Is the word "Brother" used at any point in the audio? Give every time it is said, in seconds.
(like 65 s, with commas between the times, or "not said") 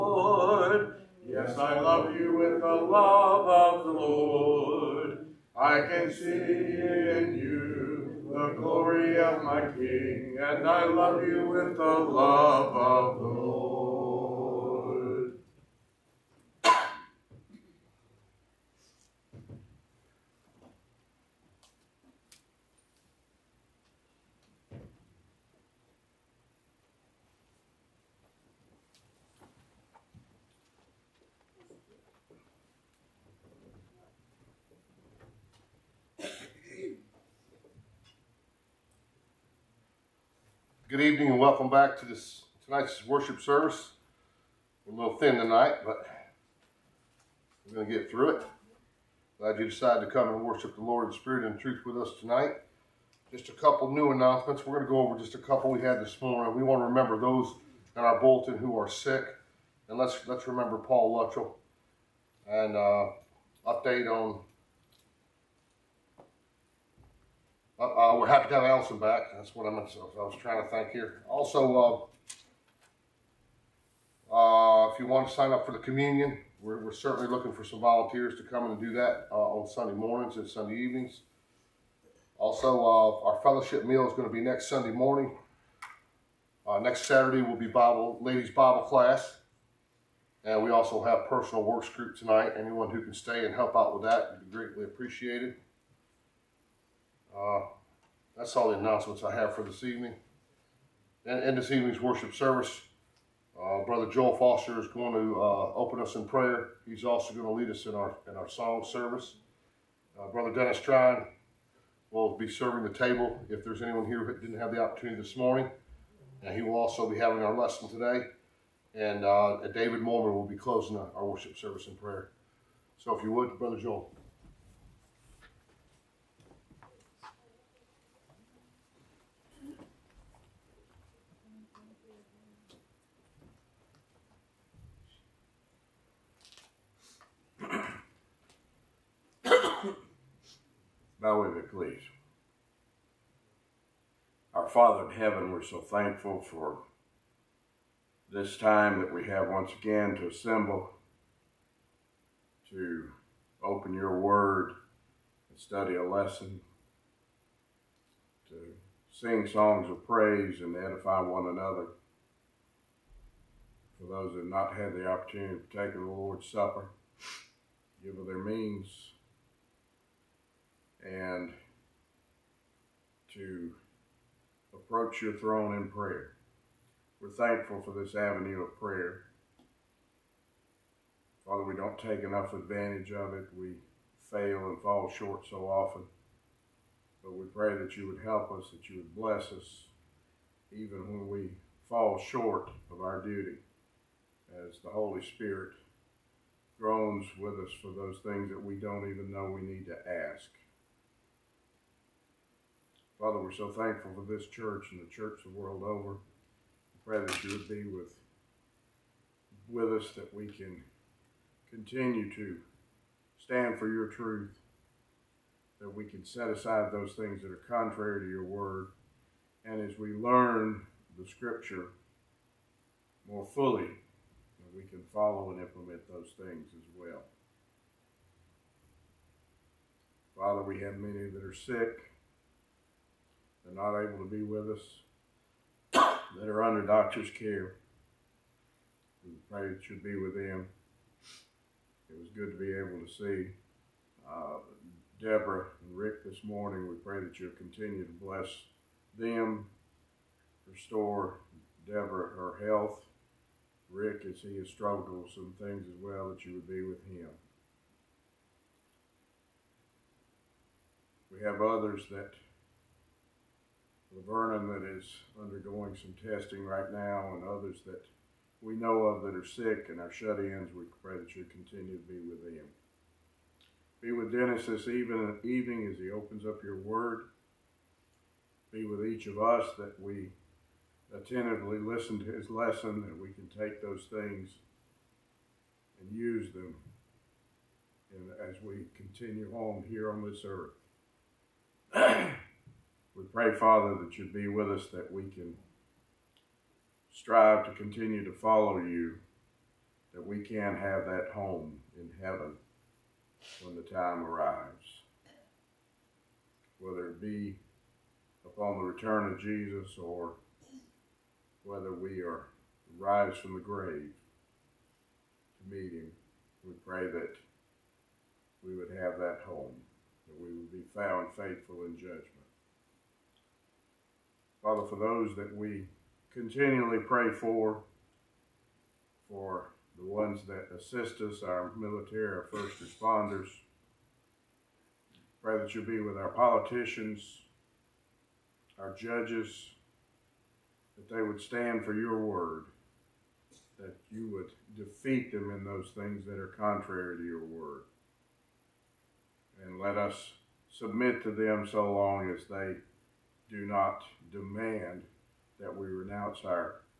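103 s, 110 s, 123 s.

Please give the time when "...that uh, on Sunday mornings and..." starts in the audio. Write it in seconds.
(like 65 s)
78 s.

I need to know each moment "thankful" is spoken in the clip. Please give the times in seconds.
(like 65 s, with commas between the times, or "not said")
145 s, 177 s, 203 s.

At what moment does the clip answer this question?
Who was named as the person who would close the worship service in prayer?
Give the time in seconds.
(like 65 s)
119 s.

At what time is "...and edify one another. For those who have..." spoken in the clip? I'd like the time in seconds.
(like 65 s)
160 s.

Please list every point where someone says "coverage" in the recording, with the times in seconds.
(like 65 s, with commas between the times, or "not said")
not said.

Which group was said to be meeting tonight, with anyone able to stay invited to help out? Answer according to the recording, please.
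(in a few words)
Personal works group.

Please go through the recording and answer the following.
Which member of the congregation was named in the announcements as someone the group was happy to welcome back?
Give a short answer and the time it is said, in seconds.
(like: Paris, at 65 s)
Allison, at 68 s.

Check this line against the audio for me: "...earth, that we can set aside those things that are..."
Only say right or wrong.
wrong.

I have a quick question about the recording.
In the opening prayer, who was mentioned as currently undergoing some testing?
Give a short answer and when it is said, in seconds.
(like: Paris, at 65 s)
Laverne, at 264 s.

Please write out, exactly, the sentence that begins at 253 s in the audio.
Rick, as he has struggled with some things as well, that you would be with him.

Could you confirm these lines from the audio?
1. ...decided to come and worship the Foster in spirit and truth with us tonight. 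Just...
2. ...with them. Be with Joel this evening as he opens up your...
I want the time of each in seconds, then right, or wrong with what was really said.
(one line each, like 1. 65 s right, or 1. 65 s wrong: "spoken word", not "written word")
1. 49 s wrong: "Lord", not "Foster"
2. 272 s wrong: "Dennis", not "Joel".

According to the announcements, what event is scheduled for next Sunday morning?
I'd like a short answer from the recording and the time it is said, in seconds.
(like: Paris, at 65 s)
Fellowship meal, at 83 s.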